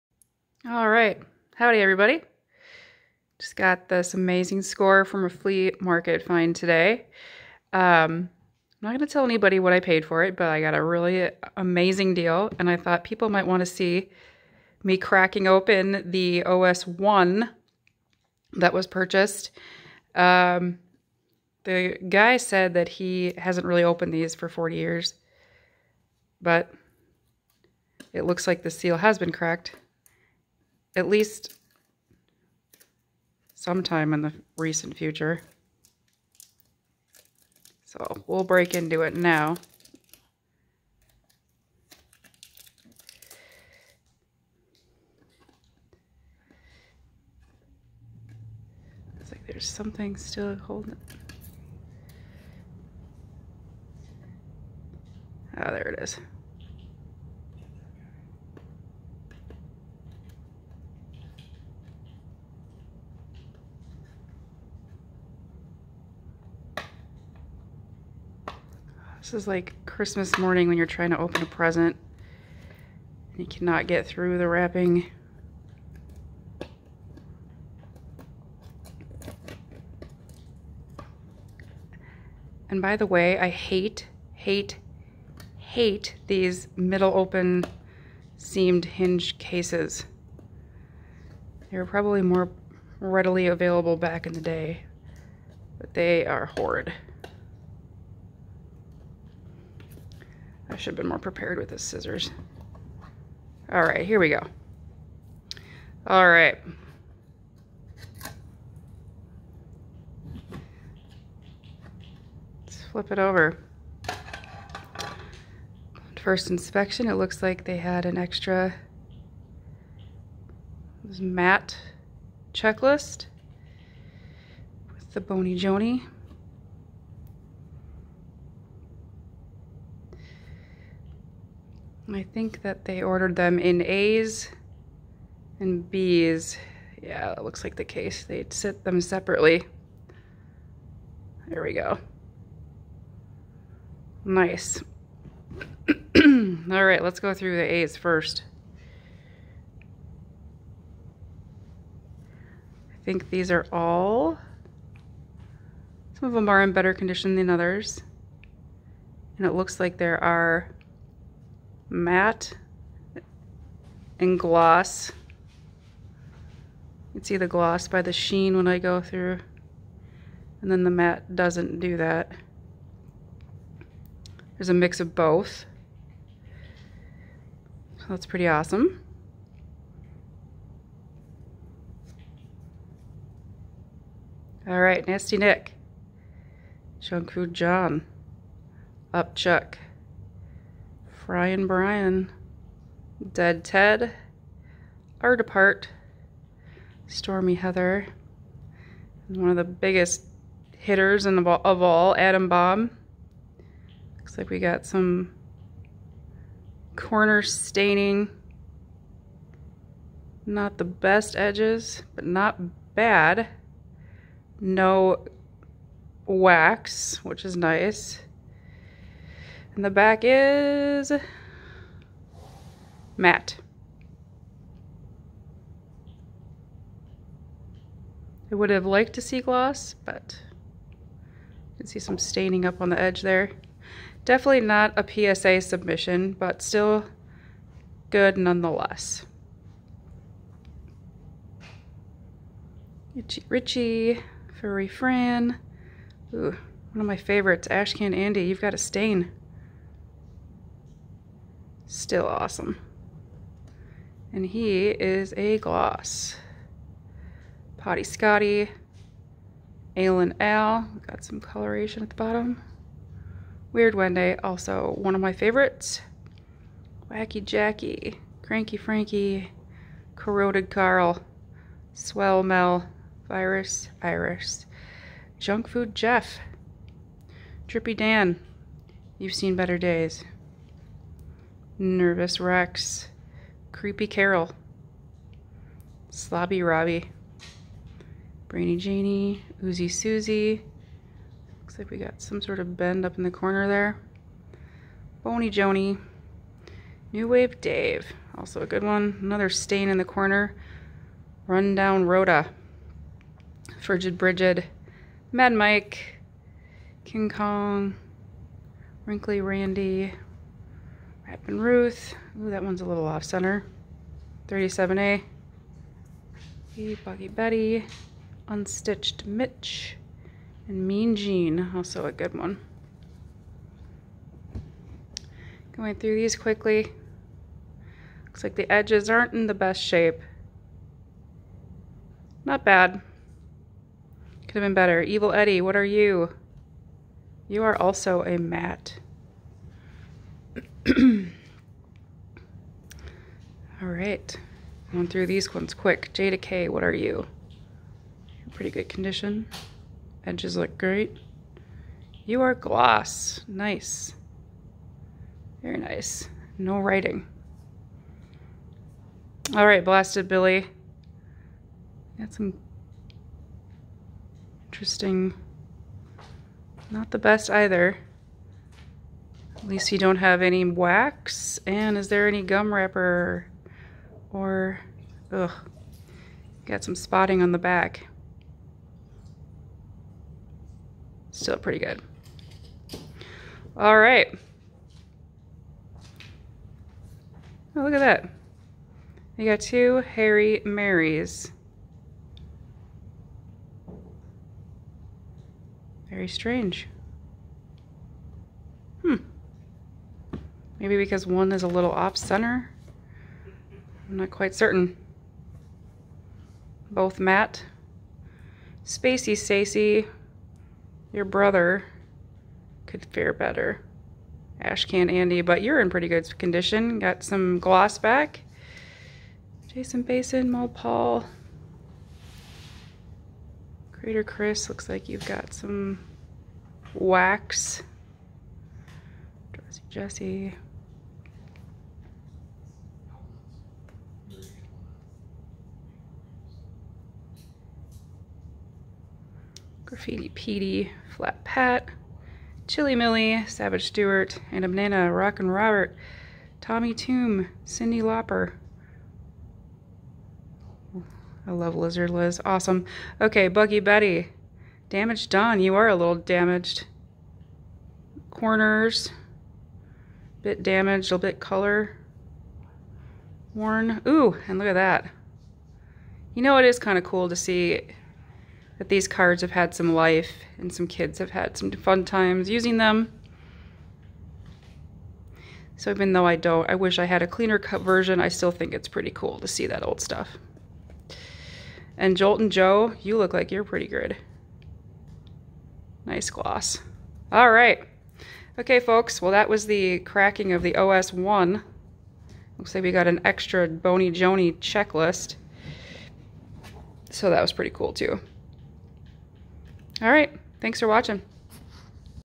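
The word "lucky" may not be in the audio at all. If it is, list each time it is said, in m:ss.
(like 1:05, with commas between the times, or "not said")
not said.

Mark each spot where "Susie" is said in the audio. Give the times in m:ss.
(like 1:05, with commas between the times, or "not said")
4:49.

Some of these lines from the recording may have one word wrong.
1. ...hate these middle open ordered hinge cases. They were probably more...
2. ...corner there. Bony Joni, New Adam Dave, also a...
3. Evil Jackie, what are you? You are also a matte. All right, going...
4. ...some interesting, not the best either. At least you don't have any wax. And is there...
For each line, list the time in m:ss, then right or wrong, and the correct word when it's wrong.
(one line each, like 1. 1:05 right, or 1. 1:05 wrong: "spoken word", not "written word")
1. 1:25 wrong: "seamed", not "ordered"
2. 4:53 wrong: "Wave", not "Adam"
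3. 5:35 wrong: "Eddie", not "Jackie"
4. 6:02 right.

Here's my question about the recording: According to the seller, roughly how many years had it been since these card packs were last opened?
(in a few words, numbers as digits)
40 years.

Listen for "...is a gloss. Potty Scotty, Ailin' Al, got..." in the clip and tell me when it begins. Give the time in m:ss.
4:14.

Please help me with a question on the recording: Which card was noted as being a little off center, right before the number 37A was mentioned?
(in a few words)
Wrappin' Ruth.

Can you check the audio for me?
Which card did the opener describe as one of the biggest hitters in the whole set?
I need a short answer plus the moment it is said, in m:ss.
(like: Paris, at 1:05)
Adam Bomb, at 3:22.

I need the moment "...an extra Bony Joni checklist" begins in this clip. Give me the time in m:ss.
8:13.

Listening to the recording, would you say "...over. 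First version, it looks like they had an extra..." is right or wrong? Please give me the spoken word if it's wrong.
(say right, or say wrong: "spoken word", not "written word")
wrong: "inspection", not "version".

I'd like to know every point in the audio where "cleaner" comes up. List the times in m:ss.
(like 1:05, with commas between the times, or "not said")
7:57.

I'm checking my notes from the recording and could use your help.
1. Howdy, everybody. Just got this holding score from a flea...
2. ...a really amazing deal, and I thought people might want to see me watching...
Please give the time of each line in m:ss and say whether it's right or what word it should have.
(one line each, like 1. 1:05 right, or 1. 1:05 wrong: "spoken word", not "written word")
1. 0:01 wrong: "amazing", not "holding"
2. 0:10 wrong: "cracking", not "watching".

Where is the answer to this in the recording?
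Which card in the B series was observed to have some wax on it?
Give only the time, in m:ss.
7:03.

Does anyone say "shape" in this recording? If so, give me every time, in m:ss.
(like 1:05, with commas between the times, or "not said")
5:29.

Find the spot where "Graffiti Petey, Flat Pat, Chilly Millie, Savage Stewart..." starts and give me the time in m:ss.
7:19.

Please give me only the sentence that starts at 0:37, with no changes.
So we'll break into it now.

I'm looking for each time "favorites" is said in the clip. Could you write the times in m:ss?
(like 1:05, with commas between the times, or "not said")
4:07, 4:25.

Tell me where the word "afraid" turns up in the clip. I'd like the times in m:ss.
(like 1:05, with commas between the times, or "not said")
not said.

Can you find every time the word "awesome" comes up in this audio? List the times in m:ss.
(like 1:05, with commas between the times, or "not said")
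2:58, 4:12, 7:32.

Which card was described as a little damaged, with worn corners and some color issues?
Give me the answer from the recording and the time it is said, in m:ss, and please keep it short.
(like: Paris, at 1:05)
Damaged Don, at 7:34.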